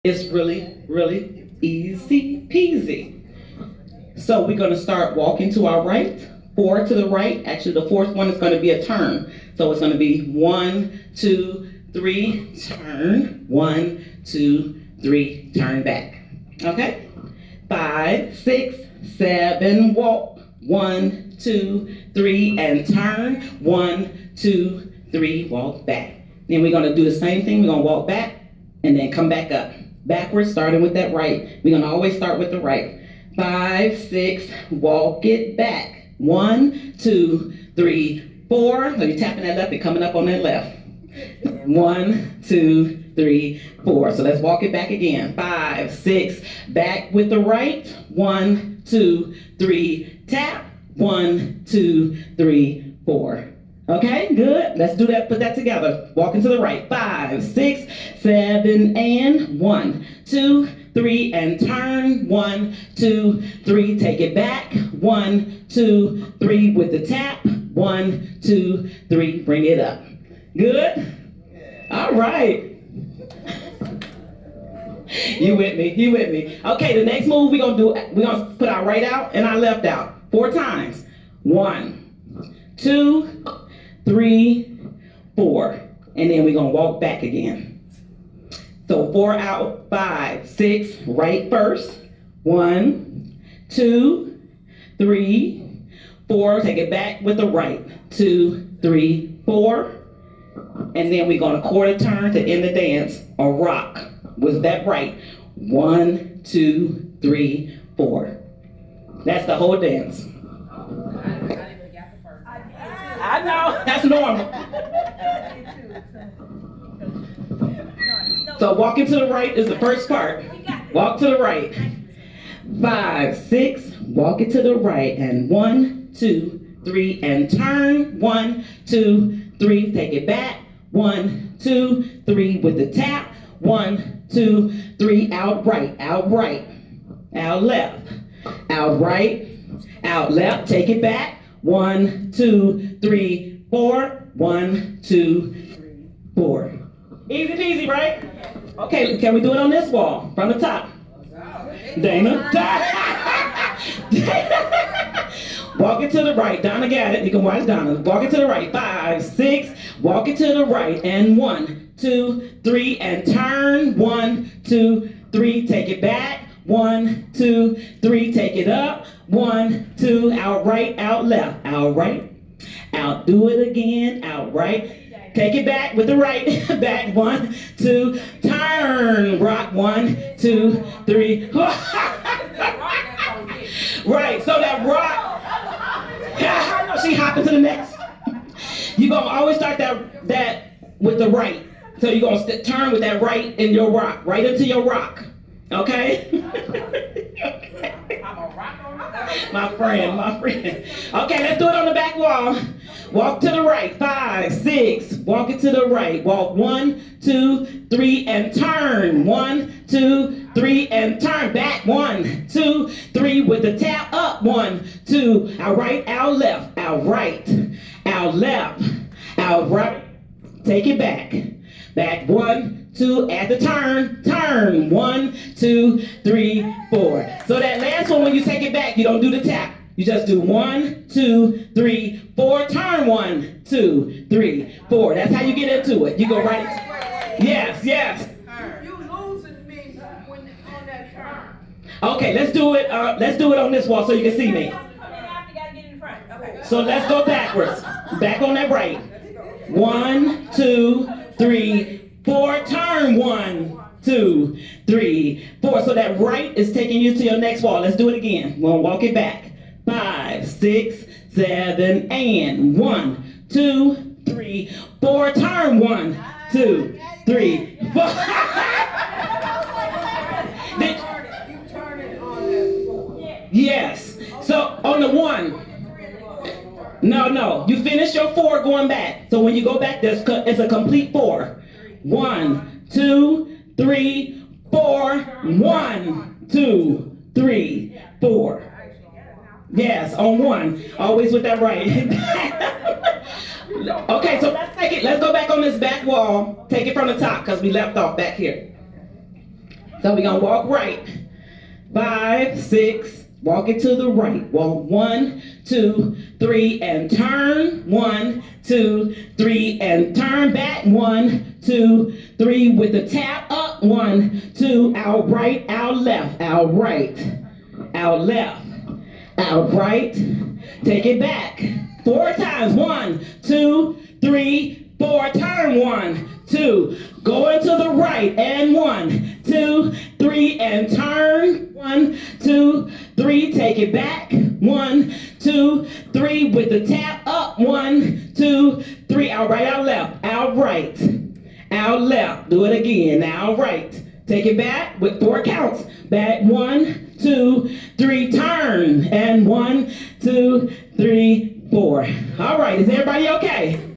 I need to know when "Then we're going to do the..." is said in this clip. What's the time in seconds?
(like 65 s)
26 s.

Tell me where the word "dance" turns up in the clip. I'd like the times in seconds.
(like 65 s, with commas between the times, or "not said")
102 s, 109 s.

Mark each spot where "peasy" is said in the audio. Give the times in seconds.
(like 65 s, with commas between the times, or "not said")
2 s, 147 s.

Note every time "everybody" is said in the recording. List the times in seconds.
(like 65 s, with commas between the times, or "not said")
352 s.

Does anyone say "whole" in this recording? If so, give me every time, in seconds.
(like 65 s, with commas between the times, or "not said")
109 s.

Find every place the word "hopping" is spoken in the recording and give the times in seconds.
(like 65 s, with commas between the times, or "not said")
187 s.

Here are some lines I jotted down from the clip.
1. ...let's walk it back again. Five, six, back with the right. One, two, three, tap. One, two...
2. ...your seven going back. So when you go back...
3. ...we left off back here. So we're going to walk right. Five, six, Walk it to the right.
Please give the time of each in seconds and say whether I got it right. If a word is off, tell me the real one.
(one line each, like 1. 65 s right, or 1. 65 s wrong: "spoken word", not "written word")
1. 44 s right
2. 278 s wrong: "four", not "seven"
3. 297 s right.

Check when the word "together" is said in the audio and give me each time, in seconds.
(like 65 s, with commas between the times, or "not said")
55 s.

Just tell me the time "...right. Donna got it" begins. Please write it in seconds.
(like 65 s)
156 s.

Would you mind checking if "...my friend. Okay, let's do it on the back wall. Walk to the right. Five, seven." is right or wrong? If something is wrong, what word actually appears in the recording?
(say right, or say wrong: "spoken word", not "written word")
wrong: "six", not "seven".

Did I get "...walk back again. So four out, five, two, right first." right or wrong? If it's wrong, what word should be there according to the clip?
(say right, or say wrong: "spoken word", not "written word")
wrong: "six", not "two".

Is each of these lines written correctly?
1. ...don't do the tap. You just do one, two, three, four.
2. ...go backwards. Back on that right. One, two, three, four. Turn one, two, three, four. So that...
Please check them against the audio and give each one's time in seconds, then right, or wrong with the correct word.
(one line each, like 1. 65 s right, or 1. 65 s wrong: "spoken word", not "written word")
1. 229 s right
2. 247 s right.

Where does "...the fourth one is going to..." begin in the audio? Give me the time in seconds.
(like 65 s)
7 s.